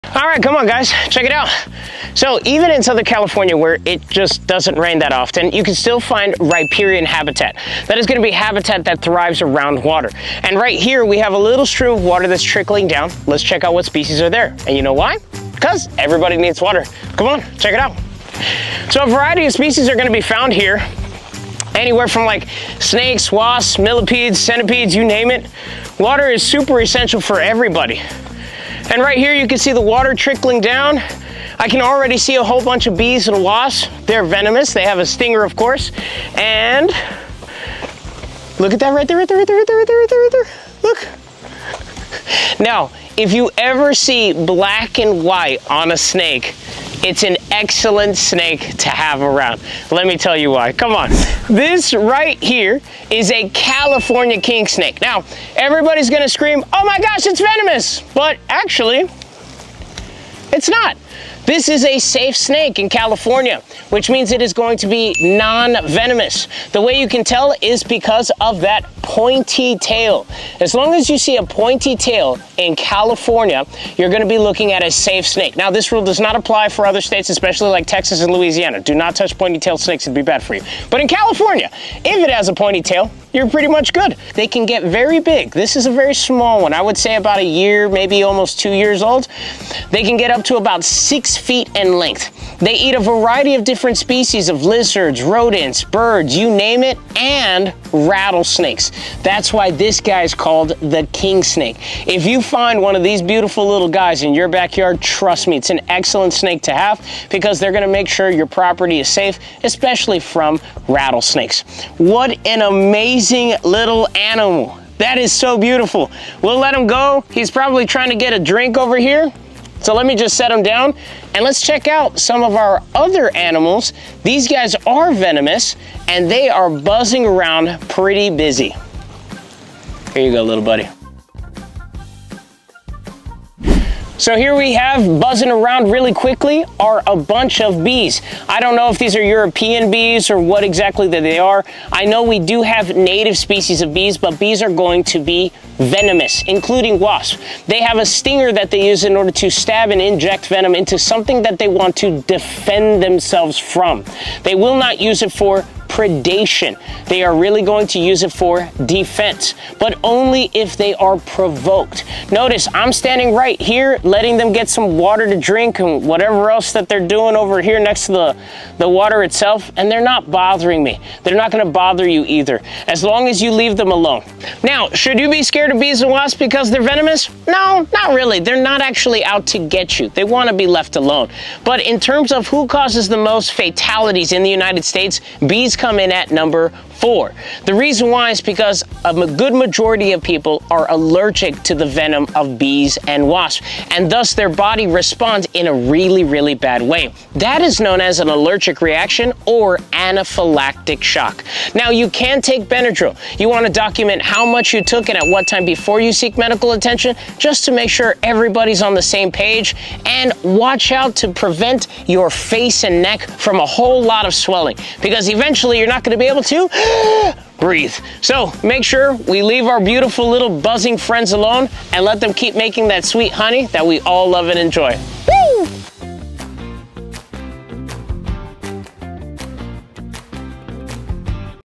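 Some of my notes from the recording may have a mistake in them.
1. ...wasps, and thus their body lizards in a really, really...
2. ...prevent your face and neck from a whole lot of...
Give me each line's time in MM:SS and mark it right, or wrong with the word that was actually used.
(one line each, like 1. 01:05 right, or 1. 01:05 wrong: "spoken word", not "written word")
1. 03:13 wrong: "responds", not "lizards"
2. 03:31 right.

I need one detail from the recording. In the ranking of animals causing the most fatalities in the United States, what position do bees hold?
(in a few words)
Number 4.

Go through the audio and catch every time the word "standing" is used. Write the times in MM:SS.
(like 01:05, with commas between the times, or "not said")
02:42.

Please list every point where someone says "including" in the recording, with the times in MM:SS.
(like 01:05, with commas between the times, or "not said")
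02:26.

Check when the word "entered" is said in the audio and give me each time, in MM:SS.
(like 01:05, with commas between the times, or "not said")
not said.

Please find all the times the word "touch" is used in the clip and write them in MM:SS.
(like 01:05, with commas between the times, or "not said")
01:19.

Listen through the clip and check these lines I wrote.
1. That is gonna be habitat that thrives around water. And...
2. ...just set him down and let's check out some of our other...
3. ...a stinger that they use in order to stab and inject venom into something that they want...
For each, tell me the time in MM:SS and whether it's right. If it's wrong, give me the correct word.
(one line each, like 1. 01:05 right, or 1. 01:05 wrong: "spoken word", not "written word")
1. 00:07 right
2. 02:00 right
3. 02:27 right.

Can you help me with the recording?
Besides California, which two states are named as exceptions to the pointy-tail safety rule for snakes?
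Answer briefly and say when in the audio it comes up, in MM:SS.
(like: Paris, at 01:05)
Texas and Louisiana, at 01:17.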